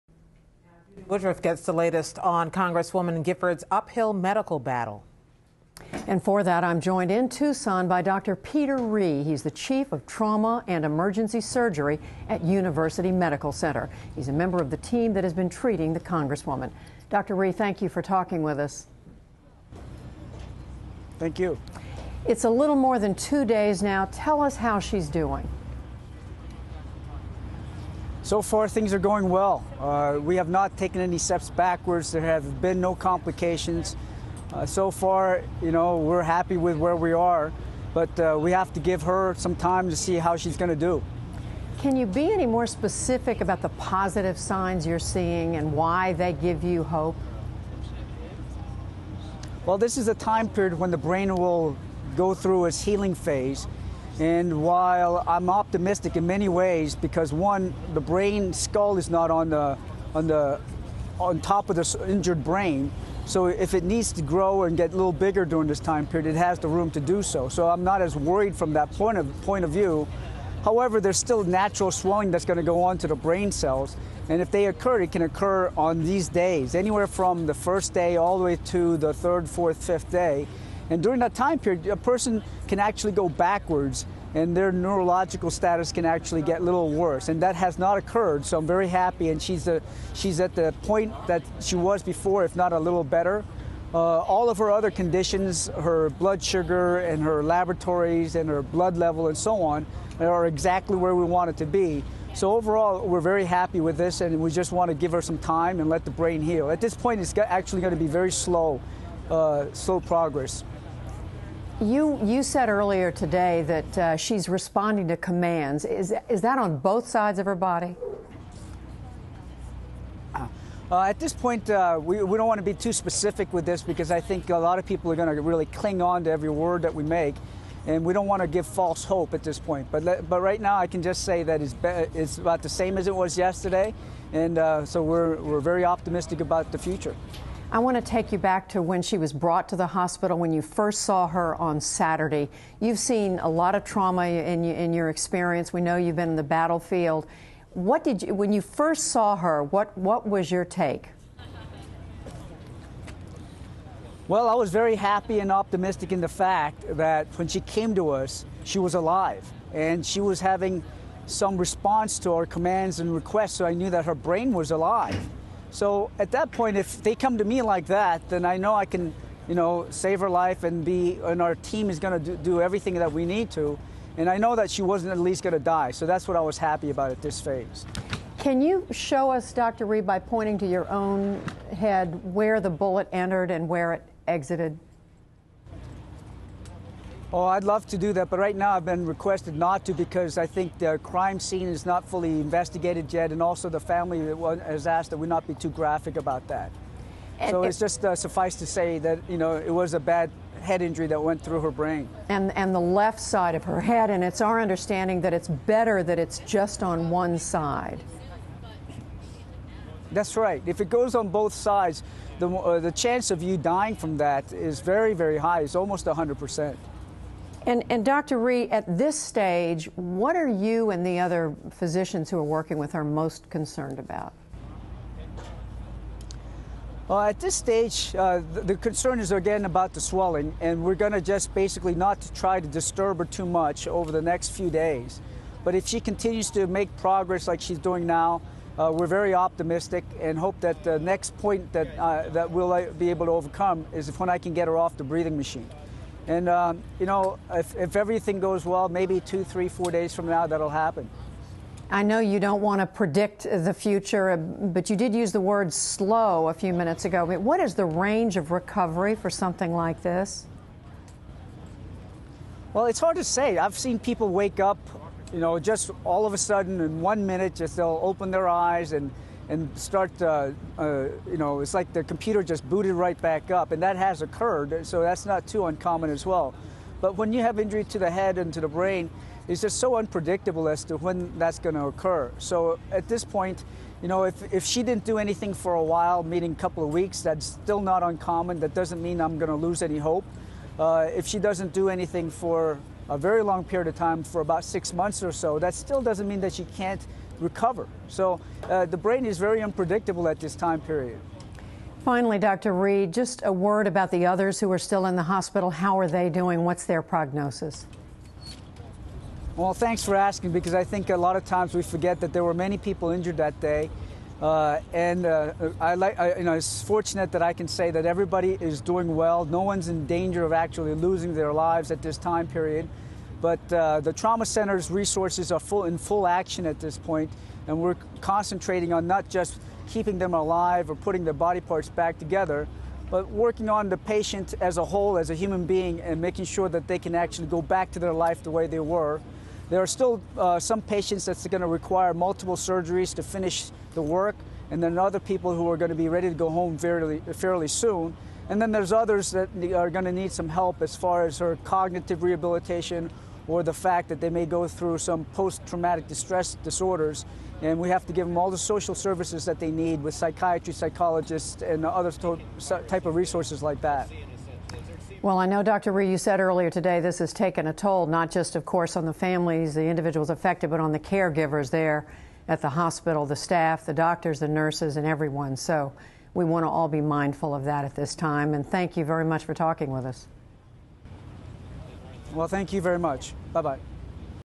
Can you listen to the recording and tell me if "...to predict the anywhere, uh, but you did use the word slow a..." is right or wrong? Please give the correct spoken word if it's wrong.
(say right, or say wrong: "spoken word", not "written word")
wrong: "future", not "anywhere".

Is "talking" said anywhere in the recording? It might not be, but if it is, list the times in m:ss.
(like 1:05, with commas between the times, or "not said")
0:18, 6:19.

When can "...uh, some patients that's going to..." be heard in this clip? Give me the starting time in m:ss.
5:40.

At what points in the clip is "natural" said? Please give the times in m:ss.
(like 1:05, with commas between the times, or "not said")
1:11.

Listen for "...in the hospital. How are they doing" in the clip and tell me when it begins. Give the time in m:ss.
5:05.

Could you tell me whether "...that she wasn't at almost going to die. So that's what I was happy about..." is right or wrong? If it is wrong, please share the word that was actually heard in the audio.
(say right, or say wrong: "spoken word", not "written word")
wrong: "least", not "almost".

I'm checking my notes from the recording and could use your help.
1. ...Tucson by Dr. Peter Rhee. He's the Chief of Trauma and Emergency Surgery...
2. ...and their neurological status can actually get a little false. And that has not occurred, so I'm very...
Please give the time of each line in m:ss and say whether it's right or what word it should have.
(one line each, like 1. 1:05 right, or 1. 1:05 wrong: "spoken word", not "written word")
1. 0:07 right
2. 1:24 wrong: "worse", not "false".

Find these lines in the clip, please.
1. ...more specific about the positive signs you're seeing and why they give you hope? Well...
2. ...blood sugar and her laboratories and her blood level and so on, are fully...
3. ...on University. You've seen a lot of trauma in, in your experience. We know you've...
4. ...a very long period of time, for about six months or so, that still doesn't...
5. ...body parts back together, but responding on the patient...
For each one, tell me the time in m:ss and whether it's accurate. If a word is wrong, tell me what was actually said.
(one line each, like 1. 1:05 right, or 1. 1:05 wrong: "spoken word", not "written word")
1. 0:42 right
2. 1:36 wrong: "exactly", not "fully"
3. 2:21 wrong: "Saturday", not "University"
4. 4:53 right
5. 5:31 wrong: "working", not "responding".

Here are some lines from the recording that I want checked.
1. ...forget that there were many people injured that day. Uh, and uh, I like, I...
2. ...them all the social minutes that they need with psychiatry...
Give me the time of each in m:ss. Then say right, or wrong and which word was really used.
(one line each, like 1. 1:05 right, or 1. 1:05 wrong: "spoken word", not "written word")
1. 5:11 right
2. 5:58 wrong: "services", not "minutes".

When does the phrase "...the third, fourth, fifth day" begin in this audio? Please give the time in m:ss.
1:18.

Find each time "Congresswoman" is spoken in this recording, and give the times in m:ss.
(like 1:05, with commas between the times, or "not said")
0:02, 0:15.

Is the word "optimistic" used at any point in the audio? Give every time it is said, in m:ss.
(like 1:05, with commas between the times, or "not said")
0:55, 2:15, 2:35, 3:59.